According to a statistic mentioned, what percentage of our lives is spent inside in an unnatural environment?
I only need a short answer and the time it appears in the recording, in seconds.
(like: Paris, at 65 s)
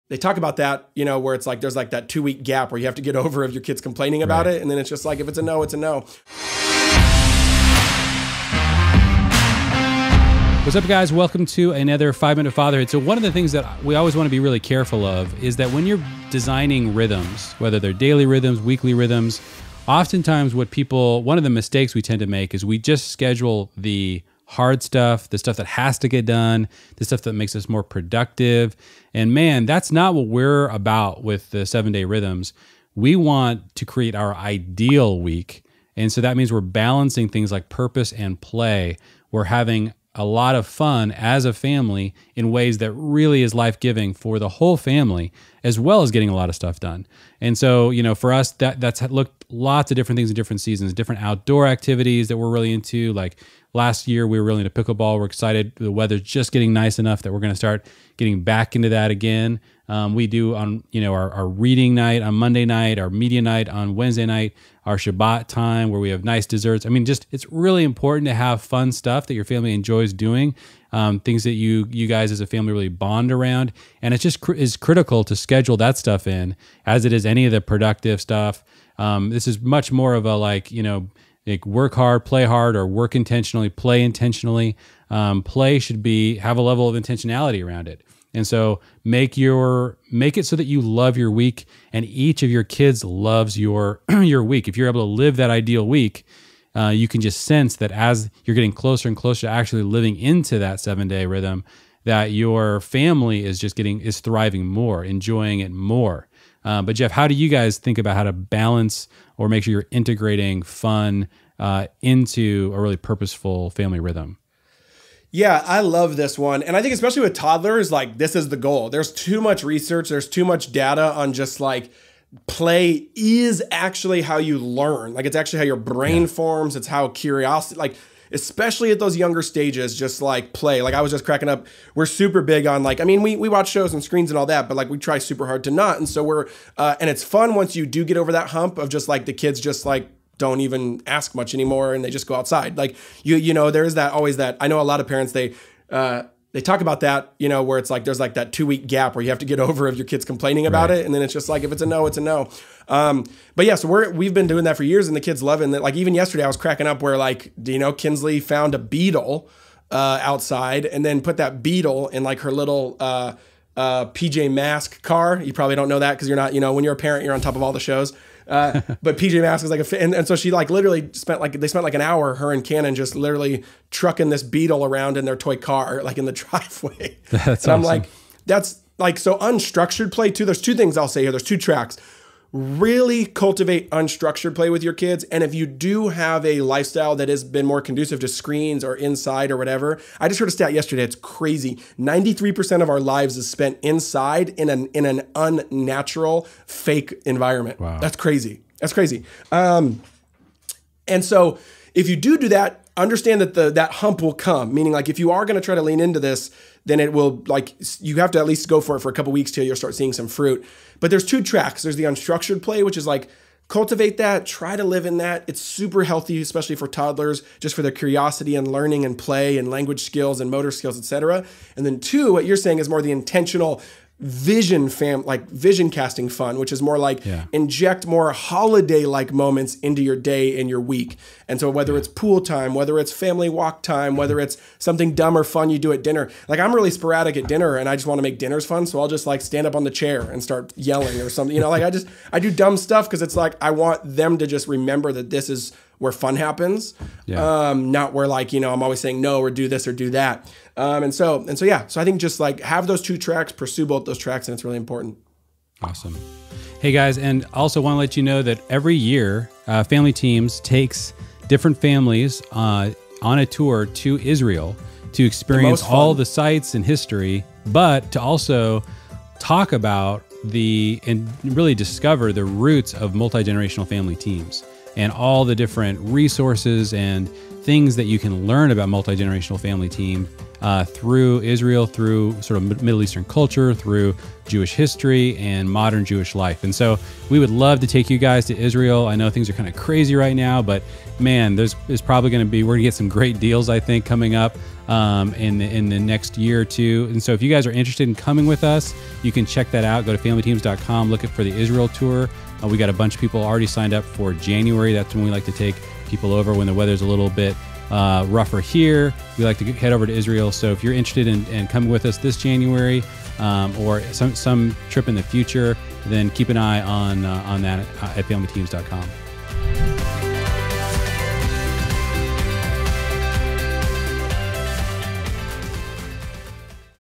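93%, at 191 s.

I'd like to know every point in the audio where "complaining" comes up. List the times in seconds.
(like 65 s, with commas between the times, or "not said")
3 s, 150 s.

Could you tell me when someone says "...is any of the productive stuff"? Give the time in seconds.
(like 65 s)
77 s.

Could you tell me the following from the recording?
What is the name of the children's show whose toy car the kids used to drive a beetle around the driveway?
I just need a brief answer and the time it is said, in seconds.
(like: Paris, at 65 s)
PJ Masks, at 164 s.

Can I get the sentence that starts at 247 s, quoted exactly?
um, not where like you know I'm always saying no or do this or do that.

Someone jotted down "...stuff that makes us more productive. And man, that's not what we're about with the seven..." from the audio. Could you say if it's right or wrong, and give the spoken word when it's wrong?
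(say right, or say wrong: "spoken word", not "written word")
right.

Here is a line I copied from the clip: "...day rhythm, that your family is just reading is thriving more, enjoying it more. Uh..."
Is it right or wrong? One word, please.
wrong.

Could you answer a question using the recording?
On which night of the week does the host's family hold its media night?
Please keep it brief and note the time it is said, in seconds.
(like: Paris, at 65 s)
Wednesday, at 63 s.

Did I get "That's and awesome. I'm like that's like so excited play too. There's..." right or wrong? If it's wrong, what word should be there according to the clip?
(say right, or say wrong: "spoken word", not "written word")
wrong: "unstructured", not "excited".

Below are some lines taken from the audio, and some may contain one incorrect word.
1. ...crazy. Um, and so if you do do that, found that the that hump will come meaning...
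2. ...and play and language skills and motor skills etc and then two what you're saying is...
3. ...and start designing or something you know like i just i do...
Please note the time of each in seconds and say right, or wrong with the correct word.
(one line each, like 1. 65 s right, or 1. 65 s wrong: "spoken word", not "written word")
1. 198 s wrong: "understand", not "found"
2. 219 s right
3. 240 s wrong: "yelling", not "designing".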